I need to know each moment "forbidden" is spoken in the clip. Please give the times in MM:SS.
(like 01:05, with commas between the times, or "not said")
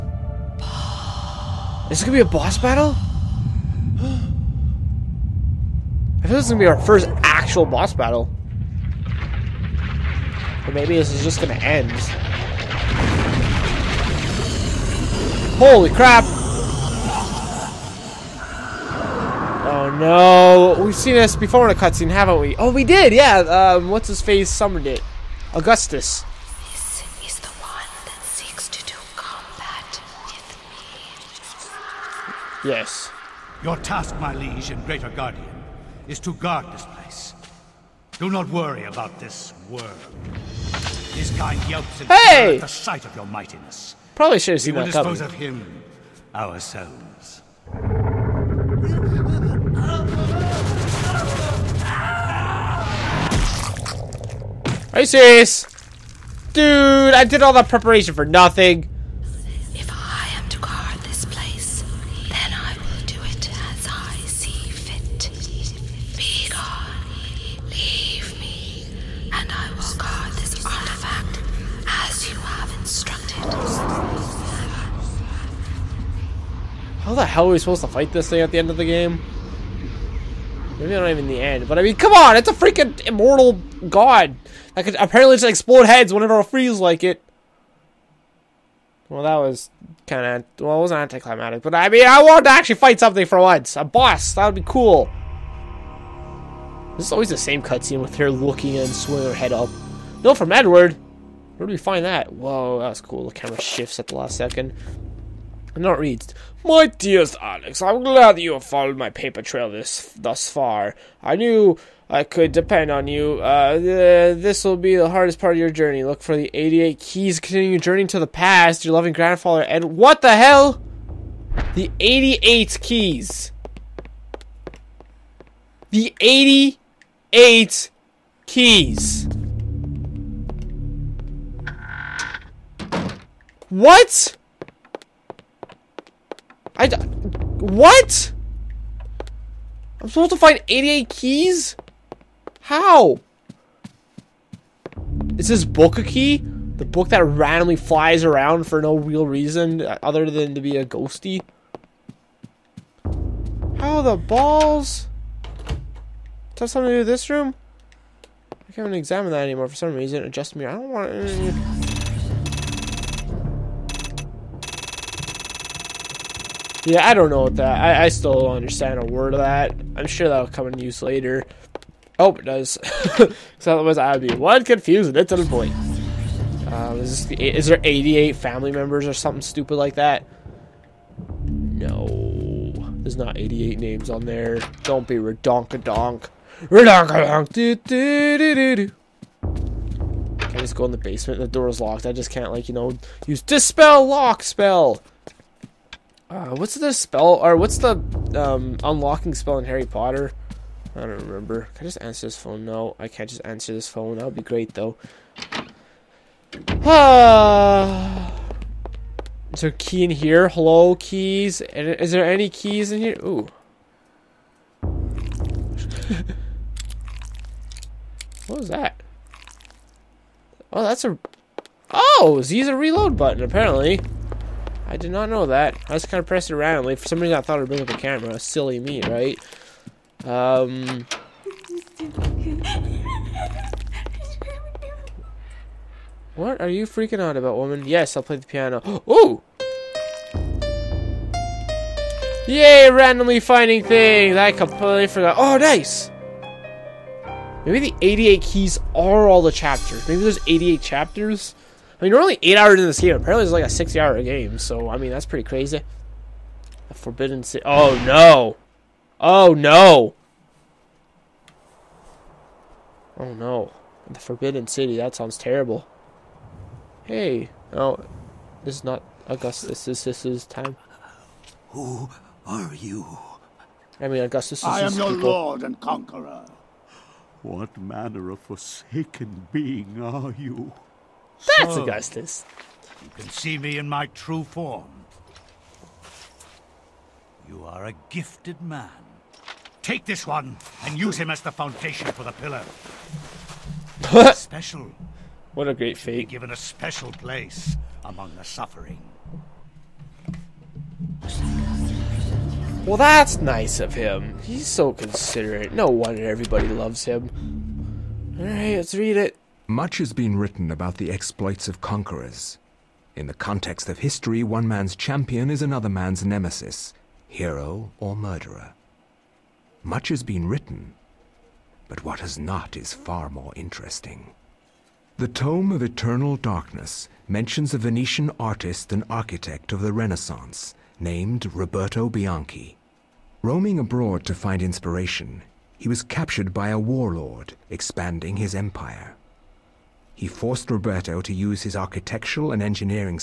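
04:16, 04:24.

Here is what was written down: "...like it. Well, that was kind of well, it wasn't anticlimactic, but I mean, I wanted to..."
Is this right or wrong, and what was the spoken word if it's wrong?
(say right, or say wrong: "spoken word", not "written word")
right.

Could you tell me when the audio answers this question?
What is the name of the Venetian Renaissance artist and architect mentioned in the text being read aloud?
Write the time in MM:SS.
05:31.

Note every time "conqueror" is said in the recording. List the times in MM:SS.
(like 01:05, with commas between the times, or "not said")
04:35, 05:11.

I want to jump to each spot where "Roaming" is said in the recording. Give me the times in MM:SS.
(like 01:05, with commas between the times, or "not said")
05:33.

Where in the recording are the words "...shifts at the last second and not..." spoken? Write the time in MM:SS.
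01:43.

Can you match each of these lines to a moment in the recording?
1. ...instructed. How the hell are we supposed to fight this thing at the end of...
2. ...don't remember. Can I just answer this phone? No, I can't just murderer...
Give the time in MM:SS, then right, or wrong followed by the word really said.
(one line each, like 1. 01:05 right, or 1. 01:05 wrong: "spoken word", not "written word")
1. 01:12 right
2. 03:20 wrong: "answer", not "murderer".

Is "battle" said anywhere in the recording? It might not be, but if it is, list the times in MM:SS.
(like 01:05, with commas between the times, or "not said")
00:02, 00:07.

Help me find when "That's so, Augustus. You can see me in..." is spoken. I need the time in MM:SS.
04:41.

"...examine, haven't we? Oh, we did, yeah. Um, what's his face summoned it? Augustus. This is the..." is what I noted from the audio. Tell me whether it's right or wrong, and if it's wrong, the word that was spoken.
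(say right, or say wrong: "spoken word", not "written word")
wrong: "cutscene", not "examine".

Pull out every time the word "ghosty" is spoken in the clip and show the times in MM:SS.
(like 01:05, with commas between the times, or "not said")
02:30.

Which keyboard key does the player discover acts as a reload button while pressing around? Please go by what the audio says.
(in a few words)
Z.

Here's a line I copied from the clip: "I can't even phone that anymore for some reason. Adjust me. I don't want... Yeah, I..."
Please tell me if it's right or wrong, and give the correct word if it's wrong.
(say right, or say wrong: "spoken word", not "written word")
wrong: "examine", not "phone".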